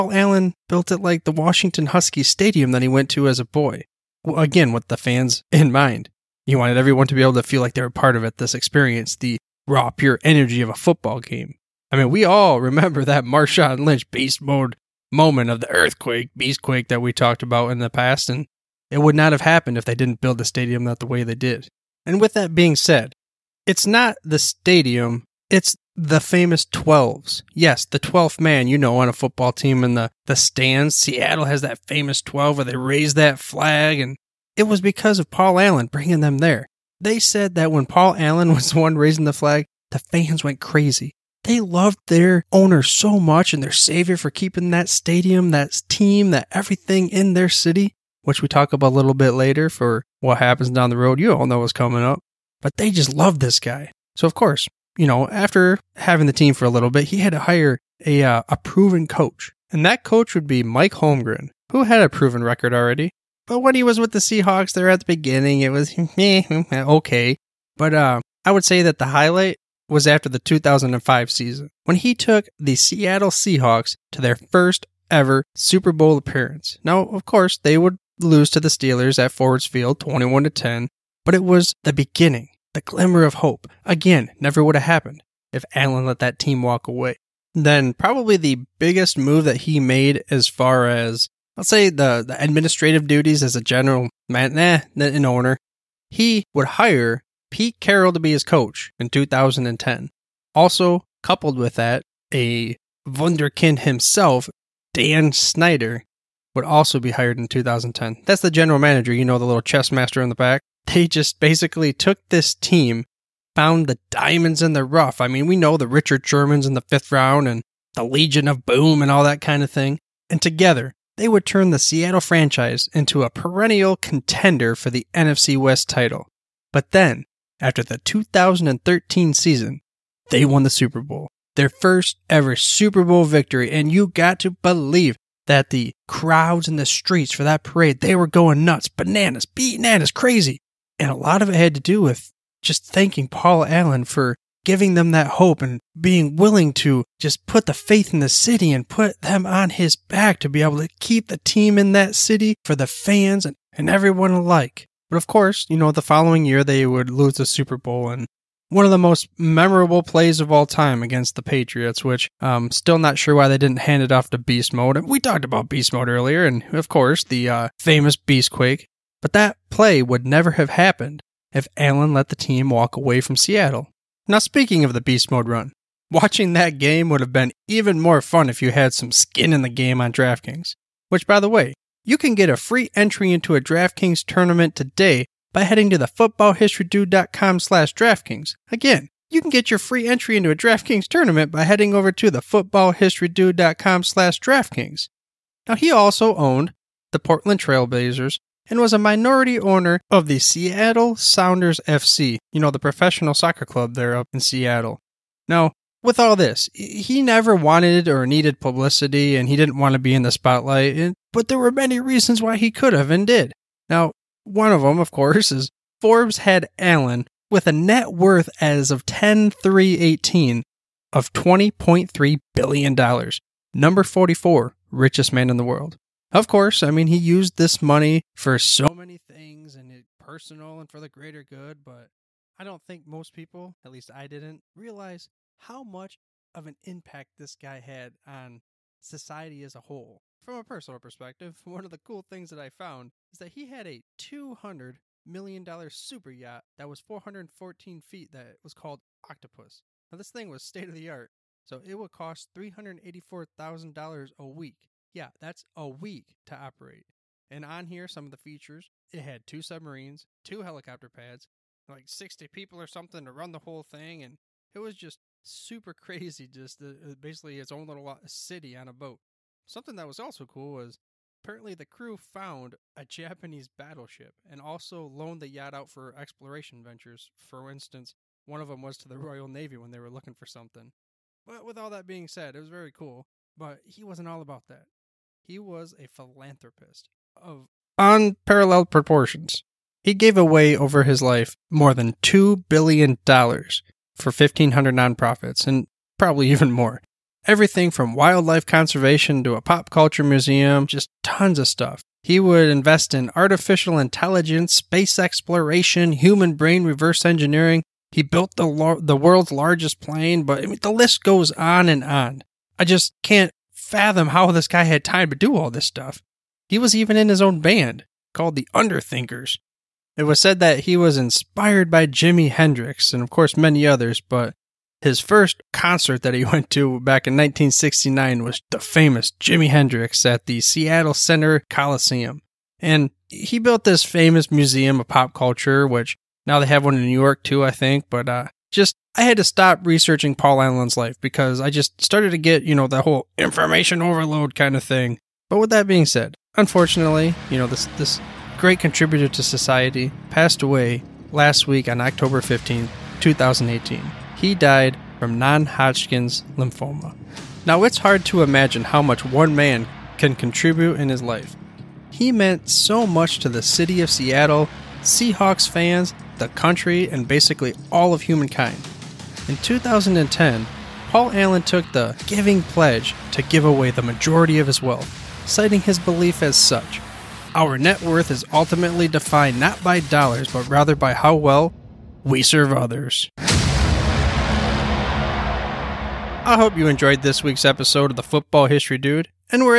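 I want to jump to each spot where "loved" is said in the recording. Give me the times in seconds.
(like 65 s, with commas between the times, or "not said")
41 s, 53 s.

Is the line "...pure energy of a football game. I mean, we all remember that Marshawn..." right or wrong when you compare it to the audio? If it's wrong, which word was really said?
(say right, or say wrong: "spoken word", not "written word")
right.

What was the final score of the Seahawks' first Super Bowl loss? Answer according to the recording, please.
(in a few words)
21 to 10.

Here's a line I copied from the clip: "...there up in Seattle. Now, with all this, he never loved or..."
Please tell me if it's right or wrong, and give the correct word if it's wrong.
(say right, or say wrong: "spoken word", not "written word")
wrong: "wanted", not "loved".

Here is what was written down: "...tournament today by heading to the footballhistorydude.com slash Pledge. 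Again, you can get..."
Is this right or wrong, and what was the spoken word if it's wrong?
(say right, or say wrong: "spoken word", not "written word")
wrong: "DraftKings", not "Pledge".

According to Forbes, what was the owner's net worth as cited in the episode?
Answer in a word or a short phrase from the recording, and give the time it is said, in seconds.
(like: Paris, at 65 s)
$20.3 billion, at 221 s.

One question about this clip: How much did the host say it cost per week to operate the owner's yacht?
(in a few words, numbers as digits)
$384,000.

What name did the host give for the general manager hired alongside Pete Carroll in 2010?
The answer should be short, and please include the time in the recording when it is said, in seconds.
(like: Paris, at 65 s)
Dan Snyder, at 104 s.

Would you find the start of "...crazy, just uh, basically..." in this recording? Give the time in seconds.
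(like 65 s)
265 s.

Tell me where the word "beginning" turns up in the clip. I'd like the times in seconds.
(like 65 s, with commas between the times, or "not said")
65 s, 81 s.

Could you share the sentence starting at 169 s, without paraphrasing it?
But that play would never have happened if Allen let the team walk away from Seattle.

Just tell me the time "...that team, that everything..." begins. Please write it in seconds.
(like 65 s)
45 s.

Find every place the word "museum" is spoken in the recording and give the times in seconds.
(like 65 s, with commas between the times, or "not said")
300 s, 334 s.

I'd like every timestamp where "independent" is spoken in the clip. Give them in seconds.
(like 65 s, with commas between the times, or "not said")
not said.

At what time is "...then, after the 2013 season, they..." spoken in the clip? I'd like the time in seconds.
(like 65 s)
126 s.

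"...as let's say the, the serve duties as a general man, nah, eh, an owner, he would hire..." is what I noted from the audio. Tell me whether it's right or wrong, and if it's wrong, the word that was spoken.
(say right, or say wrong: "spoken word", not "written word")
wrong: "administrative", not "serve".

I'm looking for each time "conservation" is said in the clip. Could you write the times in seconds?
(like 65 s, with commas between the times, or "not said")
298 s.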